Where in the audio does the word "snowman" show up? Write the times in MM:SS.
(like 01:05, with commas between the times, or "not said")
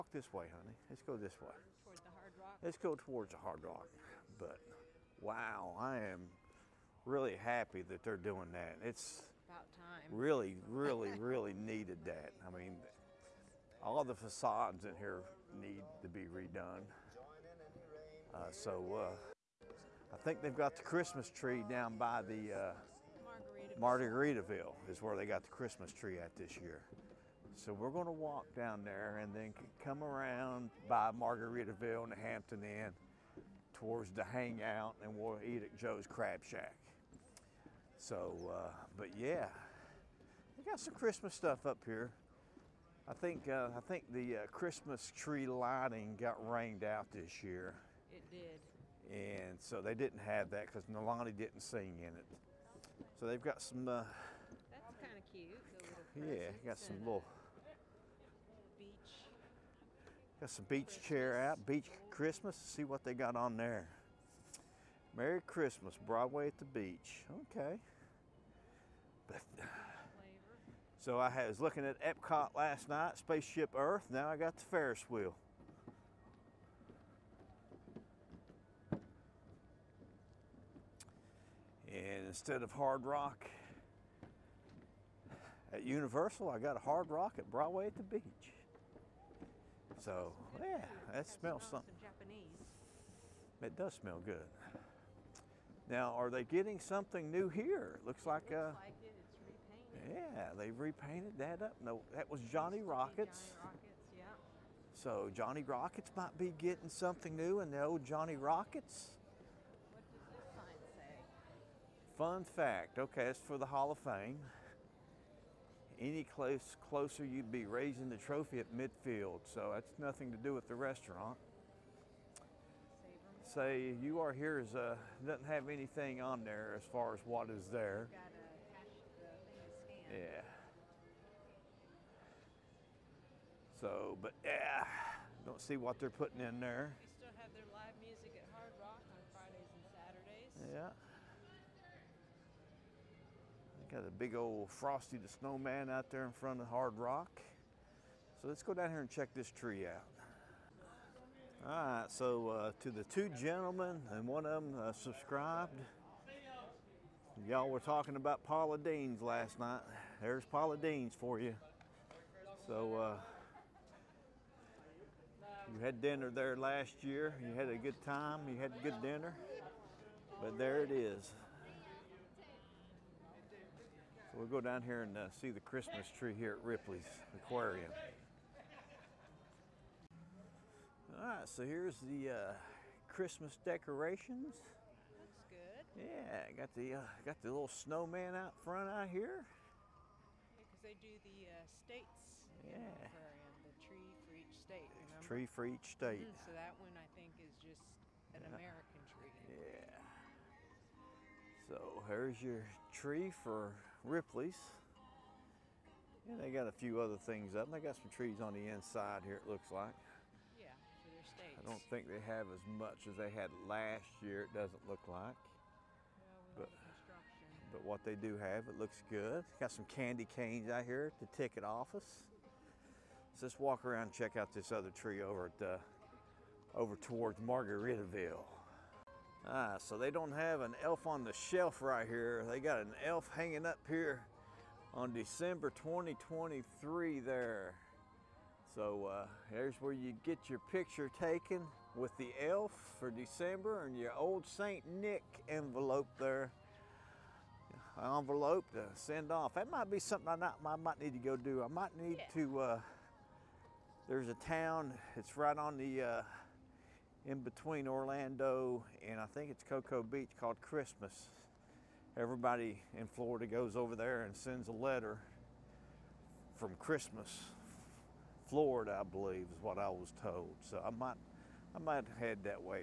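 02:25, 03:07.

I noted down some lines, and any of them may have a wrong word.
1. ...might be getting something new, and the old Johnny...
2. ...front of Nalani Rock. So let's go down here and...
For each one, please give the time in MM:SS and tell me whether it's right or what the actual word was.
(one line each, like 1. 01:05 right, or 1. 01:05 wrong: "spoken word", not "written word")
1. 01:46 right
2. 02:26 wrong: "Hard", not "Nalani".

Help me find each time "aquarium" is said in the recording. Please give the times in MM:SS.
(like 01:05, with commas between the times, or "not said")
02:57, 03:13.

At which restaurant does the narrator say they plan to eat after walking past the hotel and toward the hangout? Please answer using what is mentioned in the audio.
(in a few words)
Joe's Crab Shack.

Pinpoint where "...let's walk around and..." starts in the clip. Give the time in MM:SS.
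03:43.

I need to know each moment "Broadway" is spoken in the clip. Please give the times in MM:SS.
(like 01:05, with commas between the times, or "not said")
01:06, 01:27.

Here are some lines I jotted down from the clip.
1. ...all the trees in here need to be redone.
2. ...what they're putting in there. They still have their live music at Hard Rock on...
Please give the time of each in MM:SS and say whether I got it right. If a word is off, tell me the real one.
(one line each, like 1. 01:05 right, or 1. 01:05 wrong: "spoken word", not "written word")
1. 00:13 wrong: "facades", not "trees"
2. 02:15 right.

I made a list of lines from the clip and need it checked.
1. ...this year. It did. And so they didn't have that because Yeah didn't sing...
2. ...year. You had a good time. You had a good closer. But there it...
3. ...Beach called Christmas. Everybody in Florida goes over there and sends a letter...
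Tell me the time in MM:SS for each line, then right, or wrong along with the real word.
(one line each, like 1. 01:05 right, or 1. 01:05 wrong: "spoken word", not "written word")
1. 00:47 wrong: "Nalani", not "Yeah"
2. 02:47 wrong: "dinner", not "closer"
3. 04:20 right.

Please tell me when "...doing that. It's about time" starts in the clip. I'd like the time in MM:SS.
00:08.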